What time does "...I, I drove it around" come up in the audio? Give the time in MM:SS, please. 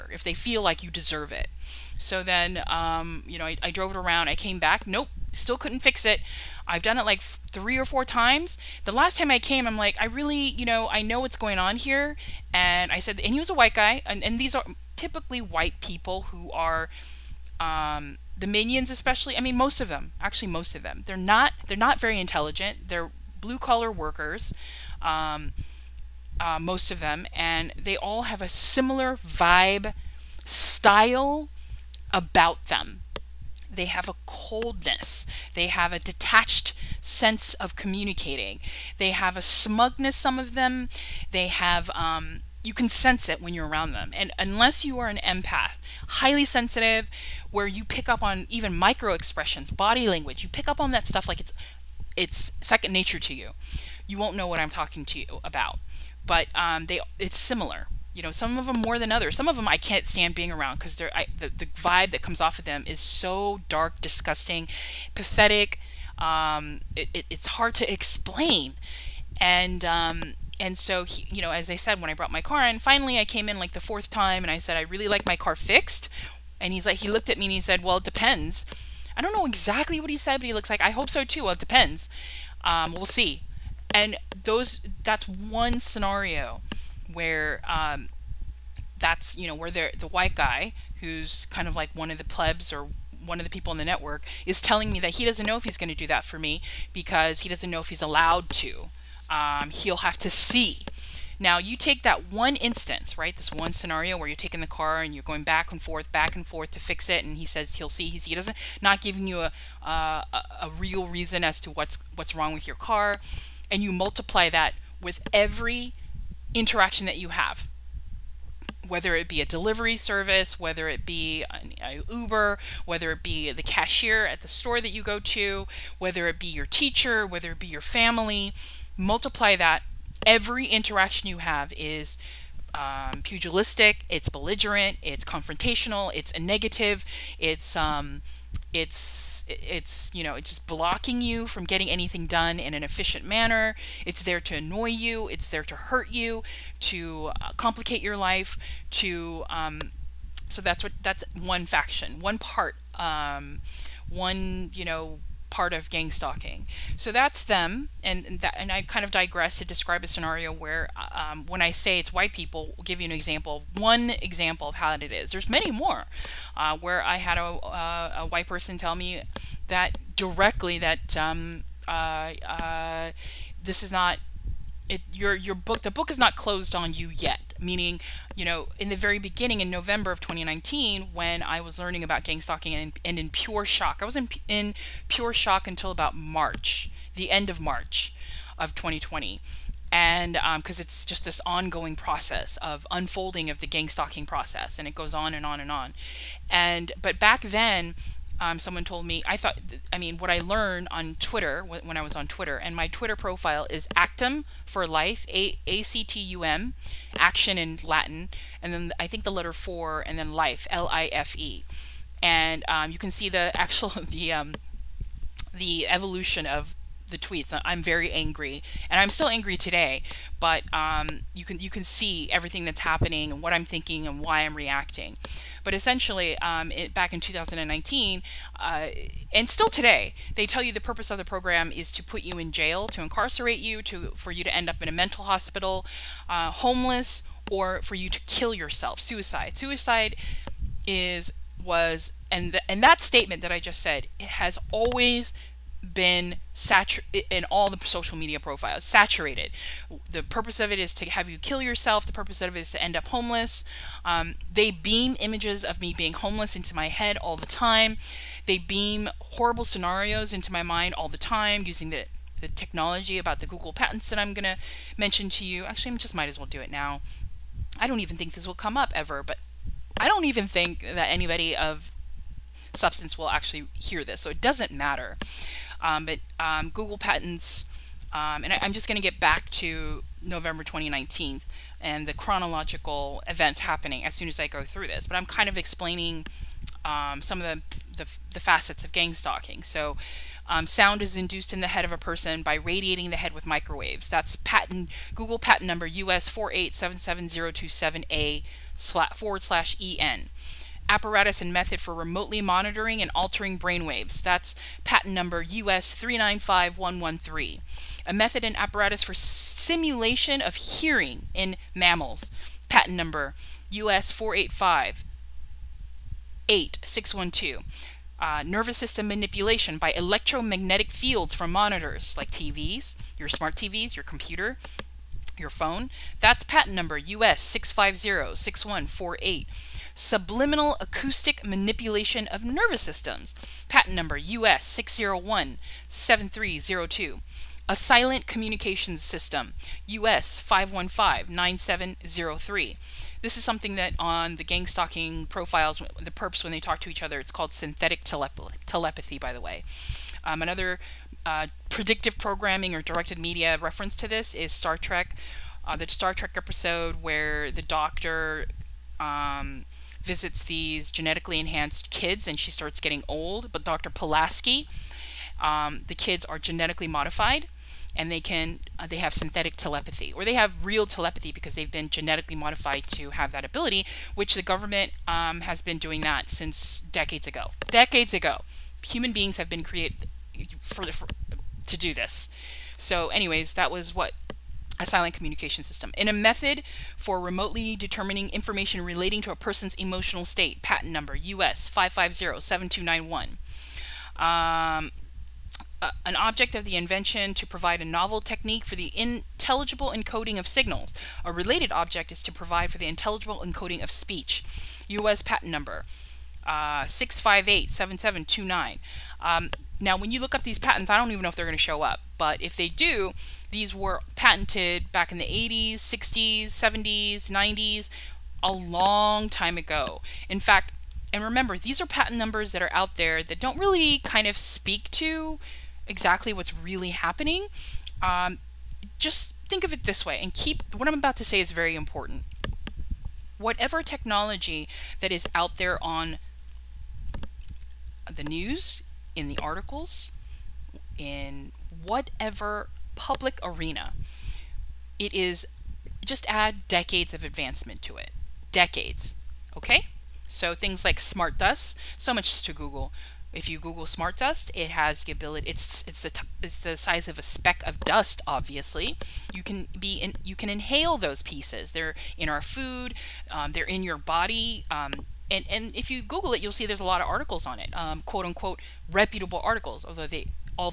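00:03.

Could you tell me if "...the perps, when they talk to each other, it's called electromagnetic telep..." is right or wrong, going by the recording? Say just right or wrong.
wrong.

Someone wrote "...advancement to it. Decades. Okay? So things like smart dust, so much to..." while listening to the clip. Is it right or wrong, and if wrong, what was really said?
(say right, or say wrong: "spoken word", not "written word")
right.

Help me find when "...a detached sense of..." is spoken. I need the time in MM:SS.
00:35.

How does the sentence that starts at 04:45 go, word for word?
But I'm kind of explaining um, some of the, the, the, facets of gang stalking.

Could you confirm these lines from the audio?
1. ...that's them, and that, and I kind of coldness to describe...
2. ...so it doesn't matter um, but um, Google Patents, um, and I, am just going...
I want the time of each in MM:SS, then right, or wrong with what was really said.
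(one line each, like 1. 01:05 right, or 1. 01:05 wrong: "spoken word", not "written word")
1. 02:37 wrong: "digress", not "coldness"
2. 04:34 right.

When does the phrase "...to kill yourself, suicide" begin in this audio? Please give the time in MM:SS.
03:58.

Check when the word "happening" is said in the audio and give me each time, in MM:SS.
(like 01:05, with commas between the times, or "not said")
03:42, 04:43, 07:06.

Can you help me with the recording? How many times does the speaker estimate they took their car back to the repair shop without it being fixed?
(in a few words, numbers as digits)
3 or 4.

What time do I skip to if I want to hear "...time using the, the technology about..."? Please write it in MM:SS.
04:21.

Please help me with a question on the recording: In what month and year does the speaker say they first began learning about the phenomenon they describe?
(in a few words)
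November 2019.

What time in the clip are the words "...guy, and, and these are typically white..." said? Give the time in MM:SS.
00:13.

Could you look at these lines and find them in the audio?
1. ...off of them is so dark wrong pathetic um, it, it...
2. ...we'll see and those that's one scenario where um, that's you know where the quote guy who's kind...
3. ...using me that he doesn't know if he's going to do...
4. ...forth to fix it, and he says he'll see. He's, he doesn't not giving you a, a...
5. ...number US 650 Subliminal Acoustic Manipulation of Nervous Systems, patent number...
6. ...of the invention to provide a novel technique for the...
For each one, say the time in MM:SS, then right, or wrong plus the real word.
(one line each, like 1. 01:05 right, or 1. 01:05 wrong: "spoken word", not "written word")
1. 01:02 wrong: "disgusting", not "wrong"
2. 01:22 wrong: "white", not "quote"
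3. 01:34 wrong: "telling", not "using"
4. 01:46 right
5. 05:26 right
6. 06:36 right.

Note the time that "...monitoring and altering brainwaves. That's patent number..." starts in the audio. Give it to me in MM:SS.
05:02.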